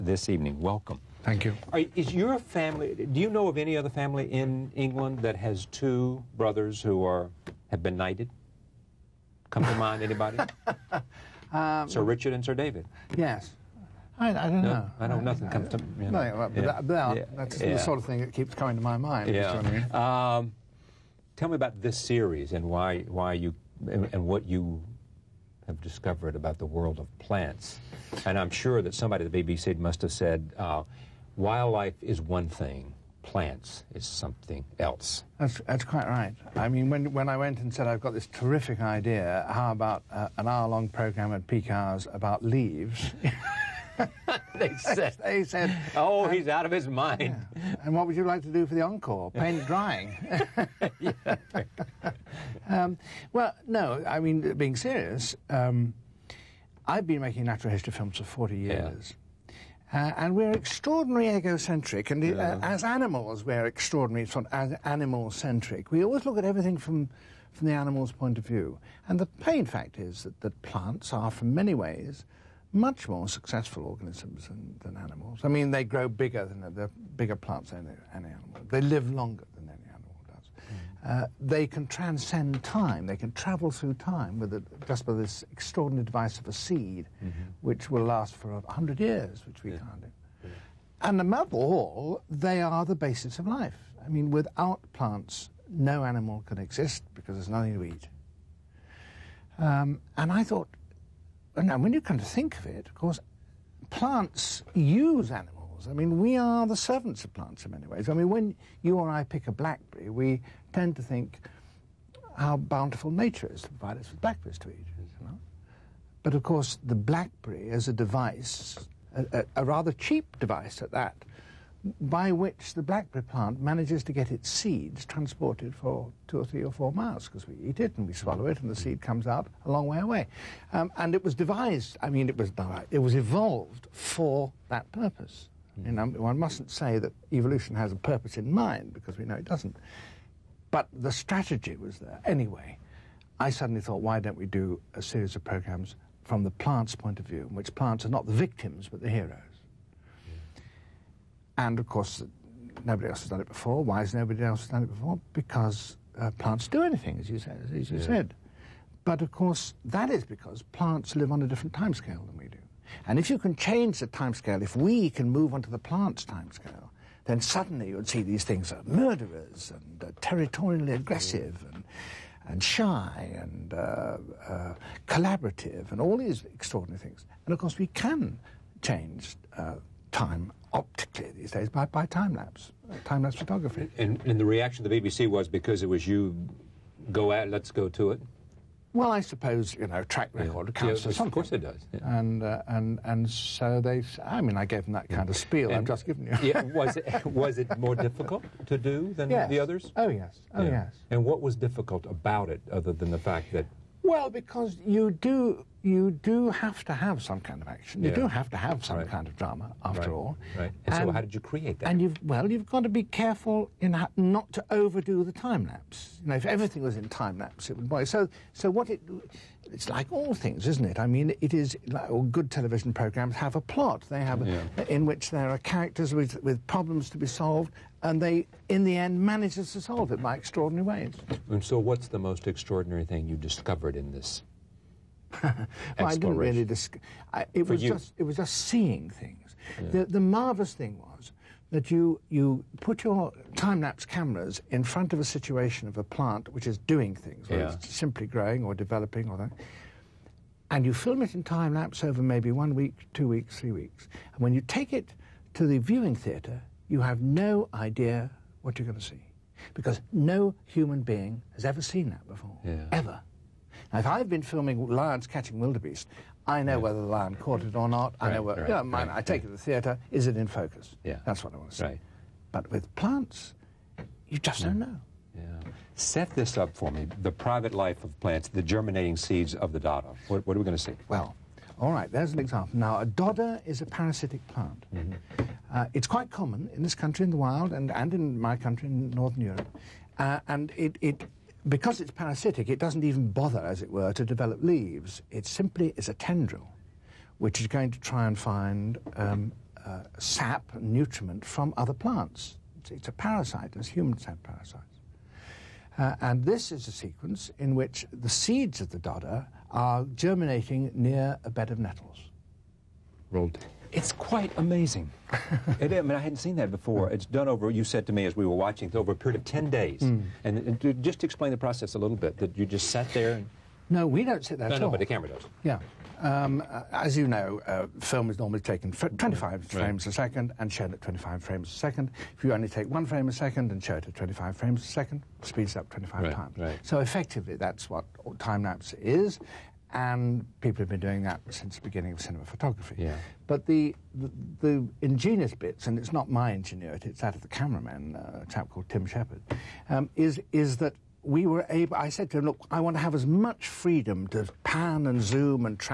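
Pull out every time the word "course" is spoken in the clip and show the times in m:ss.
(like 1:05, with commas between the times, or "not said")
1:42, 1:56, 2:31, 2:39, 2:57, 3:11.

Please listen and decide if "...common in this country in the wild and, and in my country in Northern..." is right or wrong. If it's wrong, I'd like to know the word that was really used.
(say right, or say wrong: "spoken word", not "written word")
right.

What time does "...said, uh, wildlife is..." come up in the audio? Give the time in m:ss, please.
0:30.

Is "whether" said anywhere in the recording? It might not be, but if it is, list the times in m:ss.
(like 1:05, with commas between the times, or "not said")
4:07, 4:26.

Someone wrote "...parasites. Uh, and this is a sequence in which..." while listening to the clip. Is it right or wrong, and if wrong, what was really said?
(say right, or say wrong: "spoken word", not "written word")
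right.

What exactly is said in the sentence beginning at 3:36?
You know, if everything was in time lapse, it would boy.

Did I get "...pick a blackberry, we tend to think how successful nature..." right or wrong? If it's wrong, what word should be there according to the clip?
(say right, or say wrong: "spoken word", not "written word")
wrong: "bountiful", not "successful".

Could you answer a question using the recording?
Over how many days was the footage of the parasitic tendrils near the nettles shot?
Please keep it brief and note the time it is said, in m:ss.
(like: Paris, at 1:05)
10, at 5:19.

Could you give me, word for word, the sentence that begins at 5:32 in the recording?
If you only take one frame a second and show it at 25 frames a second, speeds up 25 right.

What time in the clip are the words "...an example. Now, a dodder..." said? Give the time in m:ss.
4:42.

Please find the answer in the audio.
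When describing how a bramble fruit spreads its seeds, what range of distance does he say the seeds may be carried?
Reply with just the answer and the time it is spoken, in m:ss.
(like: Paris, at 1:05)
2 to 4 miles, at 2:06.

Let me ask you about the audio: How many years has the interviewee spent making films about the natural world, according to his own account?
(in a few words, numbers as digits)
40.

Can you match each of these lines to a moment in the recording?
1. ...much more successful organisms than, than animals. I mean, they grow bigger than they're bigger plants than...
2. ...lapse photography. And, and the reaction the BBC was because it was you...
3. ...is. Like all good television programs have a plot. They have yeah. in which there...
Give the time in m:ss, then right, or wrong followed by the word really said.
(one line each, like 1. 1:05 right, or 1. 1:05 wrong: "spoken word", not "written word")
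1. 1:12 right
2. 3:03 right
3. 3:41 right.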